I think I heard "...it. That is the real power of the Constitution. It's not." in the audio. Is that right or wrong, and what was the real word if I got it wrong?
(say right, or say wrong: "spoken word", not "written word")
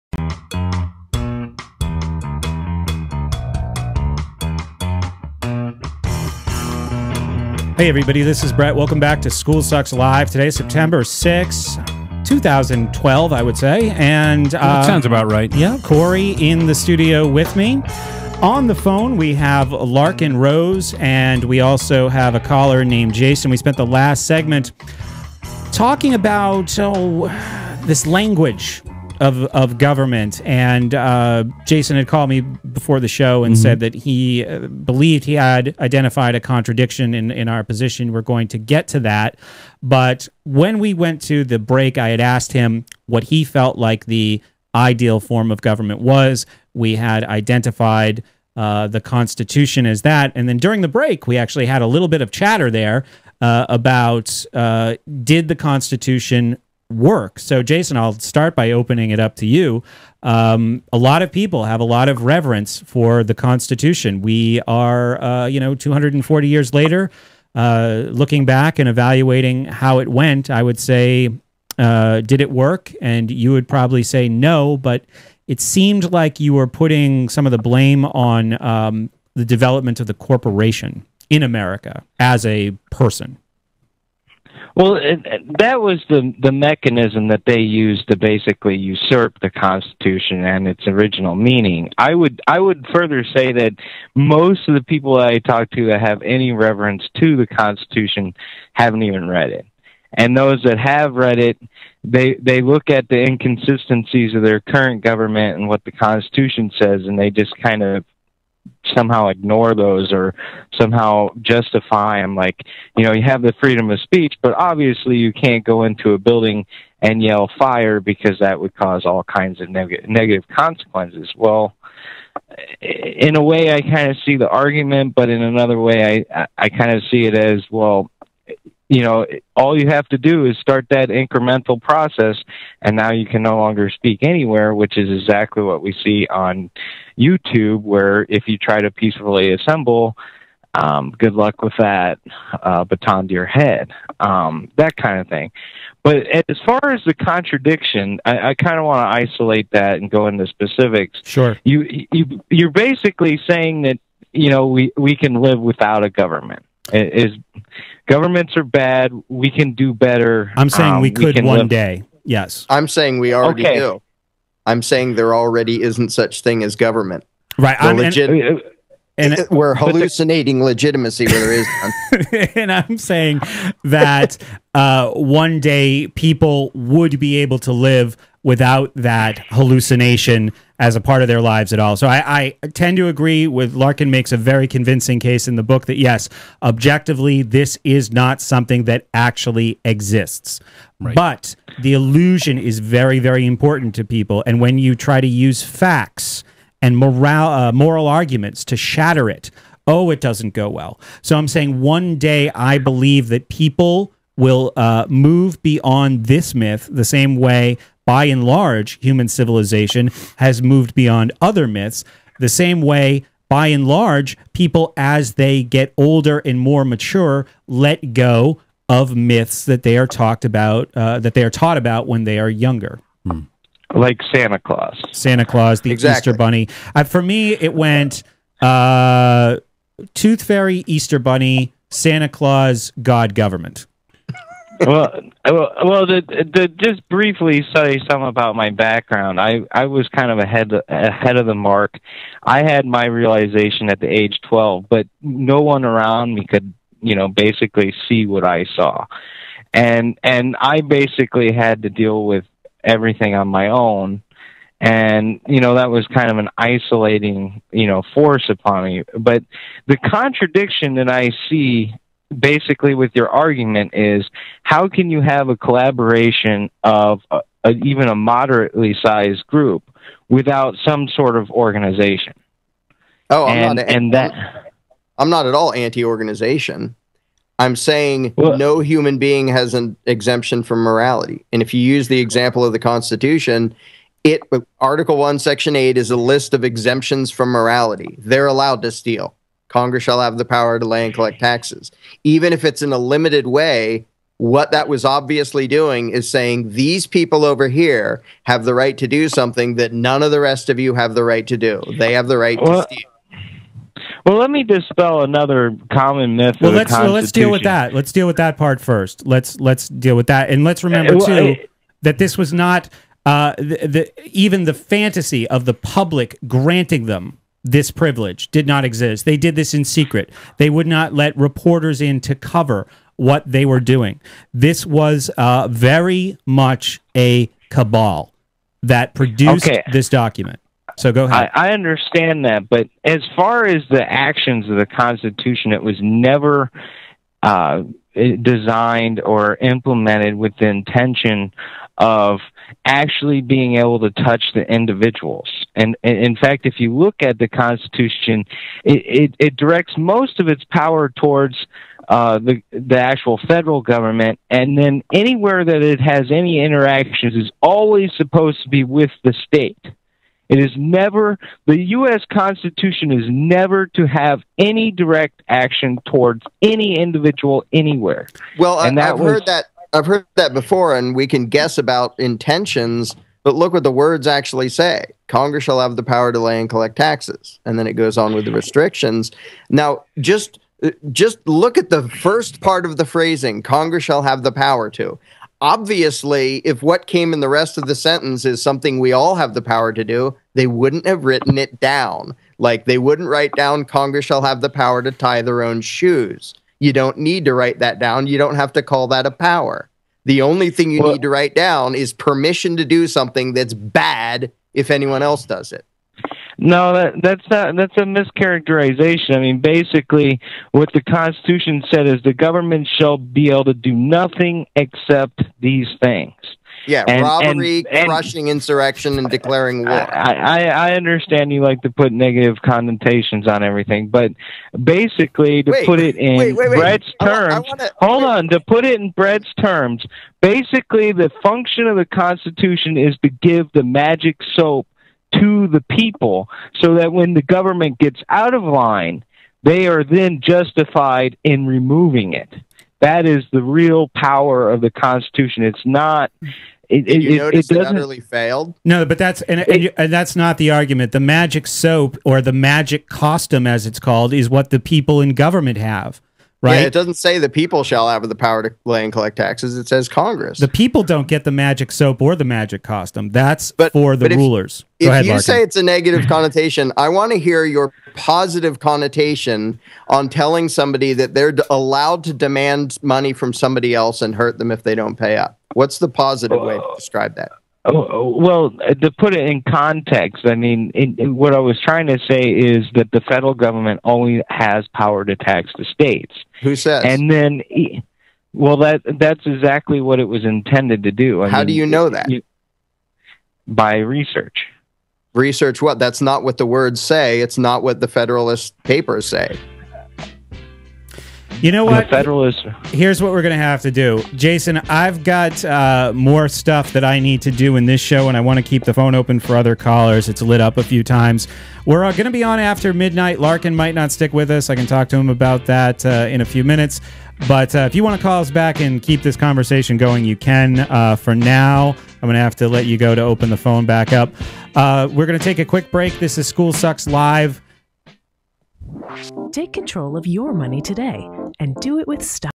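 right.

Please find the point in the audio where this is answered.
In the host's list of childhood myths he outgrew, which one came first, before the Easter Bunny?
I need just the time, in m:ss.
3:50.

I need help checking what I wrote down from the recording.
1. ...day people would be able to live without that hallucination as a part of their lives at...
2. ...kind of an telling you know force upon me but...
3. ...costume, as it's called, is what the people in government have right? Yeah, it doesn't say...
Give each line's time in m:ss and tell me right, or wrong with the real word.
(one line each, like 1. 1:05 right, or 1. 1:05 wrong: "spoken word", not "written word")
1. 2:55 right
2. 4:16 wrong: "isolating", not "telling"
3. 7:33 right.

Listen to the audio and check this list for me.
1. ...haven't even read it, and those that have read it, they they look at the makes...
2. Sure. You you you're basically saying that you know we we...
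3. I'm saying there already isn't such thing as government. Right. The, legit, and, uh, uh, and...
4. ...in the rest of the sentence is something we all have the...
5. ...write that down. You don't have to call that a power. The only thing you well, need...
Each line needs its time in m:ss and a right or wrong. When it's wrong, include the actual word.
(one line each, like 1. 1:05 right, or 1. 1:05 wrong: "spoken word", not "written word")
1. 1:38 wrong: "inconsistencies", not "makes"
2. 2:31 right
3. 2:44 right
4. 6:27 right
5. 6:37 right.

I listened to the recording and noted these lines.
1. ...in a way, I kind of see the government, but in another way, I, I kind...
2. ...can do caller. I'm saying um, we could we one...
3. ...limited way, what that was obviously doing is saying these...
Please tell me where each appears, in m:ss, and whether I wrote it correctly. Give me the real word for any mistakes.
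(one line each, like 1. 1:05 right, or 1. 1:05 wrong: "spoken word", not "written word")
1. 2:02 wrong: "argument", not "government"
2. 2:39 wrong: "better", not "caller"
3. 4:52 right.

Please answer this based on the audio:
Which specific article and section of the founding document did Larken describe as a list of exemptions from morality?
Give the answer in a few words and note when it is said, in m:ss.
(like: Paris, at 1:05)
Article 1 Section 8, at 4:44.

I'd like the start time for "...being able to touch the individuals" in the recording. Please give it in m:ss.
5:43.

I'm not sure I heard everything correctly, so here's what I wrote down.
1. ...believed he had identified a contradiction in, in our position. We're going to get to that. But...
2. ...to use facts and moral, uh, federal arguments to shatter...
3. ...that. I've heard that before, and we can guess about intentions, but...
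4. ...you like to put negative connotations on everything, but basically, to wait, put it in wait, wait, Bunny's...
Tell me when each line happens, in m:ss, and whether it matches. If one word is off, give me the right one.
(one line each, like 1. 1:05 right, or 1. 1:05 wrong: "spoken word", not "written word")
1. 0:34 right
2. 3:15 wrong: "moral", not "federal"
3. 6:09 right
4. 7:01 wrong: "Brett", not "Bunny".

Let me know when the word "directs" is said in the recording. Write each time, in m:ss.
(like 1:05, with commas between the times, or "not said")
5:49, 6:04.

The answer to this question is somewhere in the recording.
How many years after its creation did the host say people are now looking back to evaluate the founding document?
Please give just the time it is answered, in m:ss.
1:05.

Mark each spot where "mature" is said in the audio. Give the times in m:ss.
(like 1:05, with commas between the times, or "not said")
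3:36.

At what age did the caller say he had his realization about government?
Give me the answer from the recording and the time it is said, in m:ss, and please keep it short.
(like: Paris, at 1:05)
12, at 4:04.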